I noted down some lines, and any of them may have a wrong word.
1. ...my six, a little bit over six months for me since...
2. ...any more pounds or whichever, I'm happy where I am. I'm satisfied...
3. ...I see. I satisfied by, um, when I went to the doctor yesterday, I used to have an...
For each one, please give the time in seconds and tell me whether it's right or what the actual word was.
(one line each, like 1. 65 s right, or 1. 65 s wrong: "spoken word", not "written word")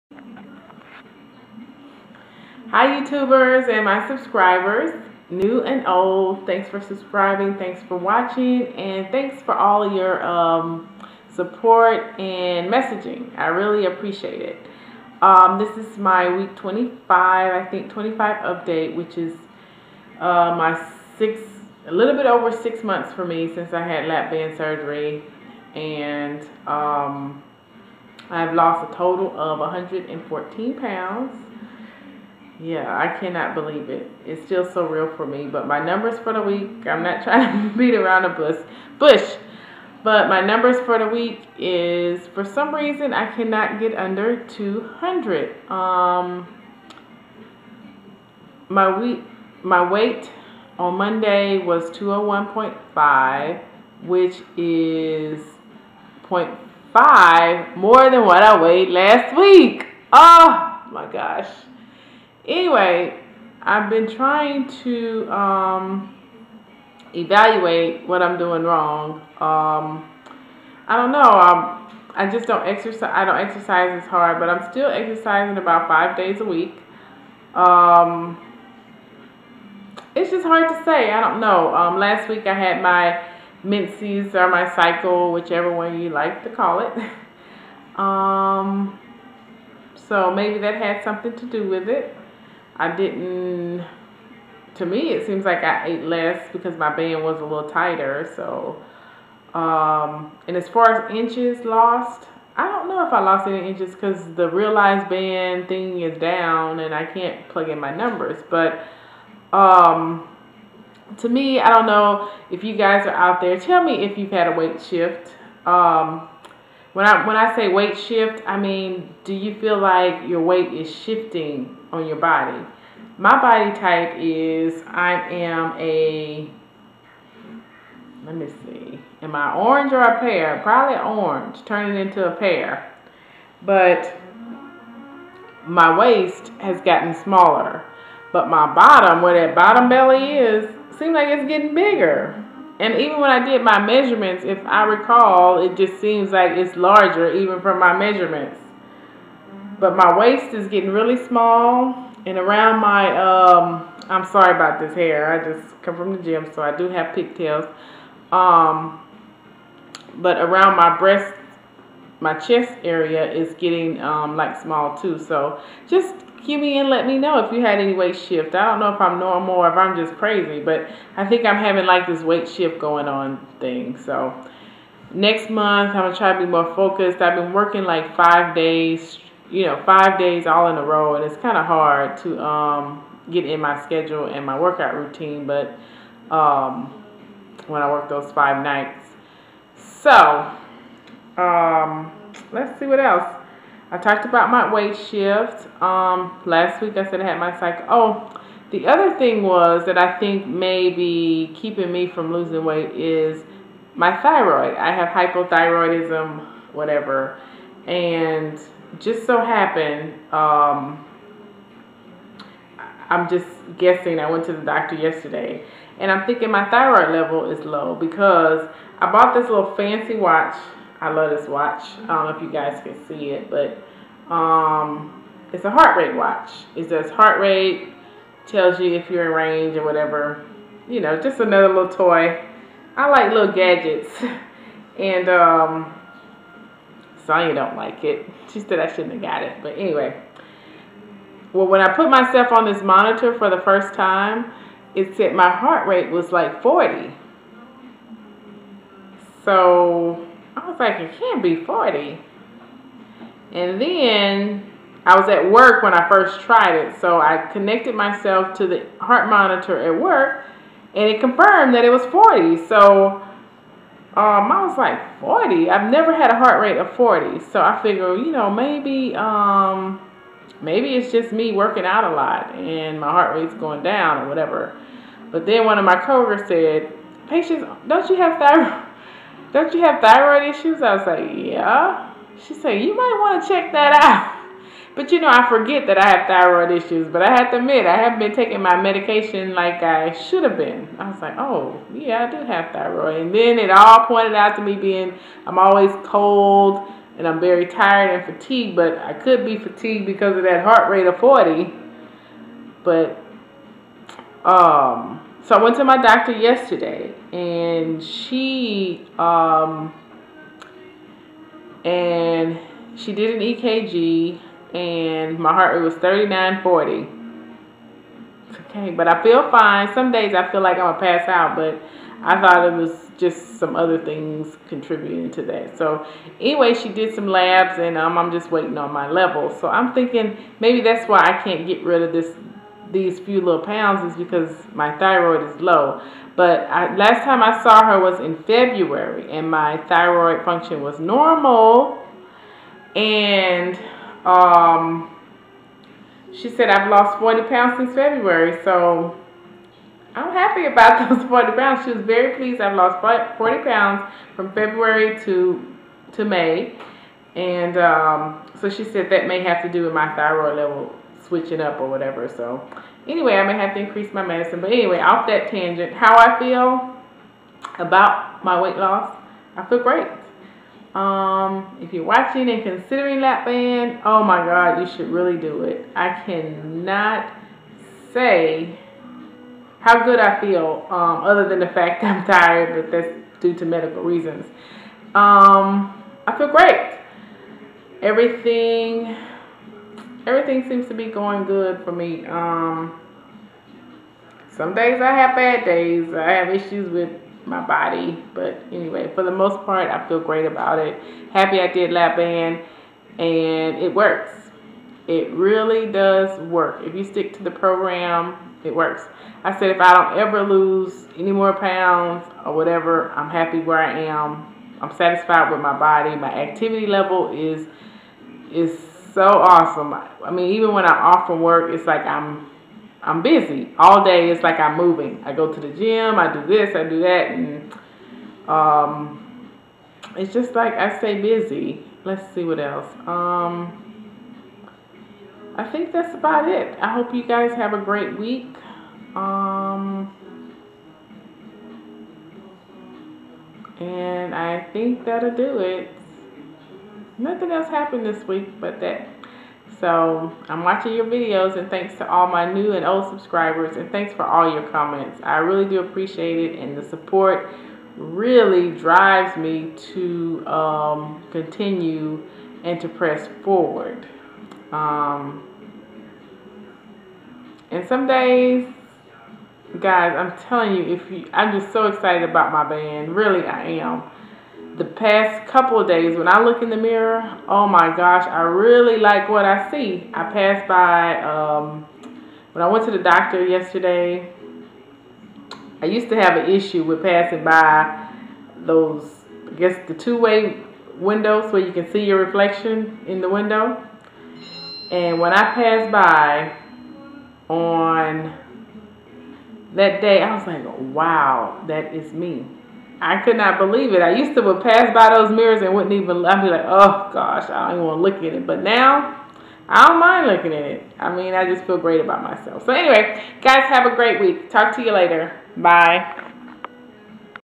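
1. 20 s right
2. 411 s wrong: "whatever", not "whichever"
3. 479 s wrong: "passed", not "satisfied".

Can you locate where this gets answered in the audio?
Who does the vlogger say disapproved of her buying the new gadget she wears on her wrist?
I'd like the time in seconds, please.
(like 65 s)
237 s.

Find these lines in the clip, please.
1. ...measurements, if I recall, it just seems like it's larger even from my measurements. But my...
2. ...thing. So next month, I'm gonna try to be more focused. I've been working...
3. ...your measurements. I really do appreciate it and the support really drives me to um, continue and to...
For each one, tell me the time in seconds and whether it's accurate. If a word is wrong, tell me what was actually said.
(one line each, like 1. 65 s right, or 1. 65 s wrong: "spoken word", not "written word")
1. 143 s right
2. 173 s right
3. 454 s wrong: "comments", not "measurements".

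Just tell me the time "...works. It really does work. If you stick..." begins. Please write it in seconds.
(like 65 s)
403 s.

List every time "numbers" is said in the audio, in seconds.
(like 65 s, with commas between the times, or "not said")
35 s, 40 s, 107 s.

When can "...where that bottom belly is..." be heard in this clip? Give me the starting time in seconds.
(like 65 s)
139 s.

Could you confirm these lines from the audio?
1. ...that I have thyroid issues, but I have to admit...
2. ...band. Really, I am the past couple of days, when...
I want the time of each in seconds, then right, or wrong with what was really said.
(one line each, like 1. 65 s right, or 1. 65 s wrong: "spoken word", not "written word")
1. 285 s right
2. 472 s right.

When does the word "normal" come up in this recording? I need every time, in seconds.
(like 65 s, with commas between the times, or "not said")
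169 s, 340 s.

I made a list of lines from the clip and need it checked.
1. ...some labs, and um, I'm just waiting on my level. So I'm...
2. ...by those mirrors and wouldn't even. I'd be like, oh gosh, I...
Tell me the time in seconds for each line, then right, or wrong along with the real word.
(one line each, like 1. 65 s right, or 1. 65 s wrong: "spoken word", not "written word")
1. 327 s right
2. 504 s right.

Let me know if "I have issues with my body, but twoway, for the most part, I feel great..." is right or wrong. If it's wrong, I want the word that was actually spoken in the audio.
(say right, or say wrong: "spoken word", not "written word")
wrong: "anyway", not "twoway".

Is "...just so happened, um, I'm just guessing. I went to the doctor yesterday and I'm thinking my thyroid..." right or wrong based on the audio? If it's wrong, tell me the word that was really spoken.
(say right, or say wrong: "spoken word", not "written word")
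right.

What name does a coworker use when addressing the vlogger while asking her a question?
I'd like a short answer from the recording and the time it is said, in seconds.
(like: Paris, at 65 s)
Patience, at 277 s.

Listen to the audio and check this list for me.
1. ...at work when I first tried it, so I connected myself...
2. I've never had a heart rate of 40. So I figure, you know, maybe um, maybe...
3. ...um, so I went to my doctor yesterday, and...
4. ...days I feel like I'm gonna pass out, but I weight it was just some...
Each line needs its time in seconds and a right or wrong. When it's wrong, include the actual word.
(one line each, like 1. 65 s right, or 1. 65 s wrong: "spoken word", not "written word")
1. 255 s right
2. 265 s right
3. 304 s right
4. 320 s wrong: "thought", not "weight".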